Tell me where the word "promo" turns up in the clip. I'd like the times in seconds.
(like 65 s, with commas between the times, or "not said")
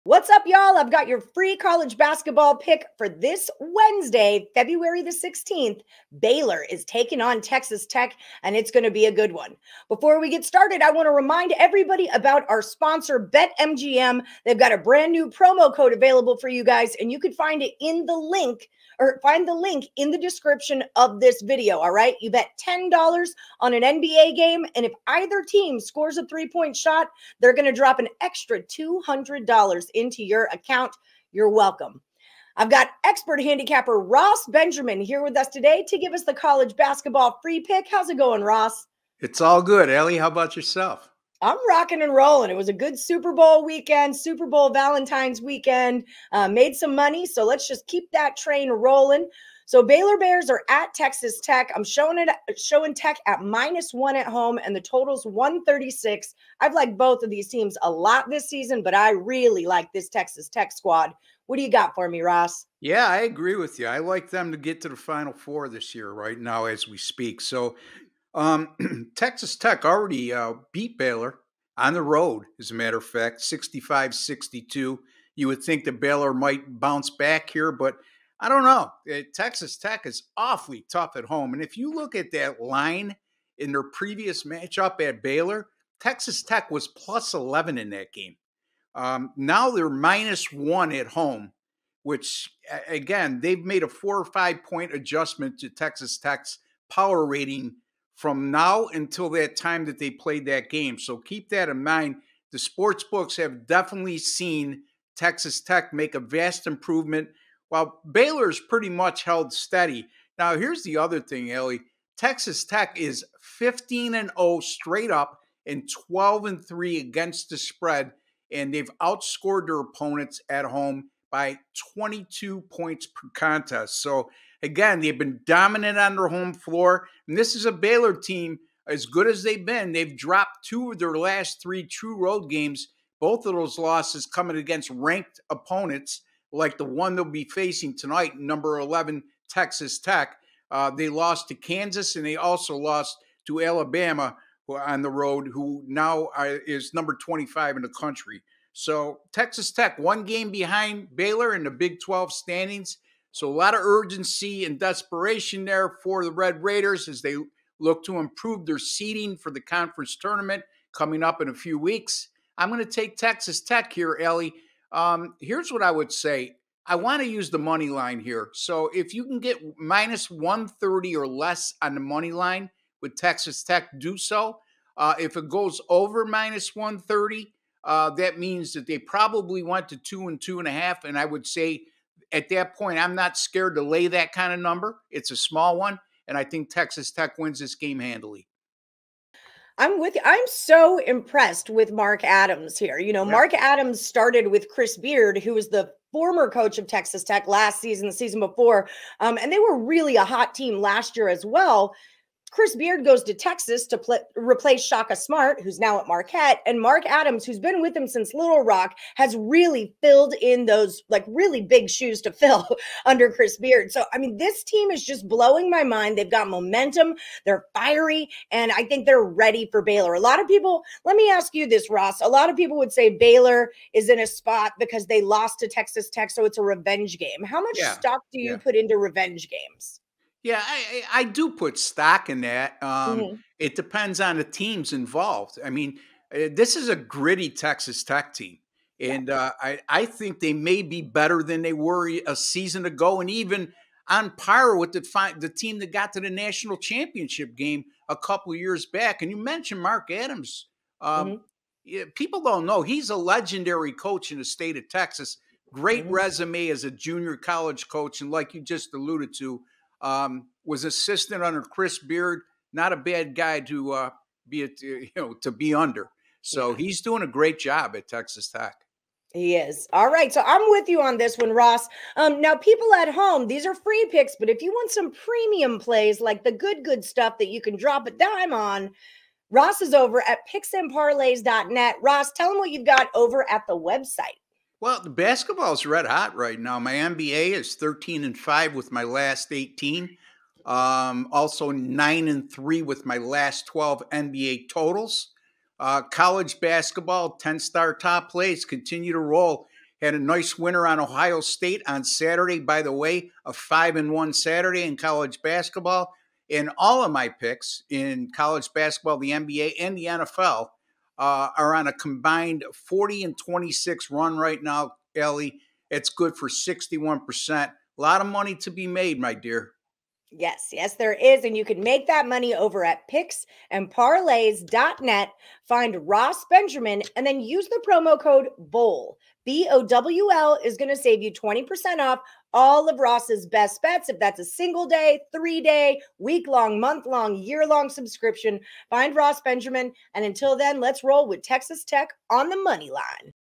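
15 s, 327 s.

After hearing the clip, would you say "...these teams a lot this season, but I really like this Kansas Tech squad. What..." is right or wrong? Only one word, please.
wrong.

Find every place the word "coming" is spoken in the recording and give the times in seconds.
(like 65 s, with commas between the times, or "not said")
134 s, 160 s.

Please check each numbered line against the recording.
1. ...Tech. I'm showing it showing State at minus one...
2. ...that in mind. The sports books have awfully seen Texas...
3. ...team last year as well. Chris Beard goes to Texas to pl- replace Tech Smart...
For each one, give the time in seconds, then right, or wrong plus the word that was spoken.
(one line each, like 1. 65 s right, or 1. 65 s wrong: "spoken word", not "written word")
1. 51 s wrong: "Tech", not "State"
2. 101 s wrong: "definitely", not "awfully"
3. 200 s wrong: "Shaka", not "Tech".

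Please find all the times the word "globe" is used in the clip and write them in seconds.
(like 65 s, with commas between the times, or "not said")
not said.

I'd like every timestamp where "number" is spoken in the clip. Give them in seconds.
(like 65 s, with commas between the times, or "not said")
138 s, 146 s, 184 s.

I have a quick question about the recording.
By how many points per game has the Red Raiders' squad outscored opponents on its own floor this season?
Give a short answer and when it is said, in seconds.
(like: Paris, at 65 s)
22, at 121 s.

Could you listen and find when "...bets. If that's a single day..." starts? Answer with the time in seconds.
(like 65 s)
333 s.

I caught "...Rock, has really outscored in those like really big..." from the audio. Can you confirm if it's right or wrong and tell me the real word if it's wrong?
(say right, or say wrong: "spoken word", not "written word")
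wrong: "filled", not "outscored".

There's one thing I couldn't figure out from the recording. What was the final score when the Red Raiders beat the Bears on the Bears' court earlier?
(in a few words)
65-62.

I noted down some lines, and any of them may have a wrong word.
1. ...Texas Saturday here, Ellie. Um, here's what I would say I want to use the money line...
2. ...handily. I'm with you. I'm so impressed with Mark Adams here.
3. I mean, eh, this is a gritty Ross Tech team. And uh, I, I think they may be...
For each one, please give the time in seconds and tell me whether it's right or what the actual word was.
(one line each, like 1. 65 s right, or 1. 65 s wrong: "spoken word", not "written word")
1. 163 s wrong: "Tech", not "Saturday"
2. 187 s right
3. 235 s wrong: "Texas", not "Ross".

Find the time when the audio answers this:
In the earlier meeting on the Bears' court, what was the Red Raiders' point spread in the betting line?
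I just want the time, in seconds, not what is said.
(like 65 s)
86 s.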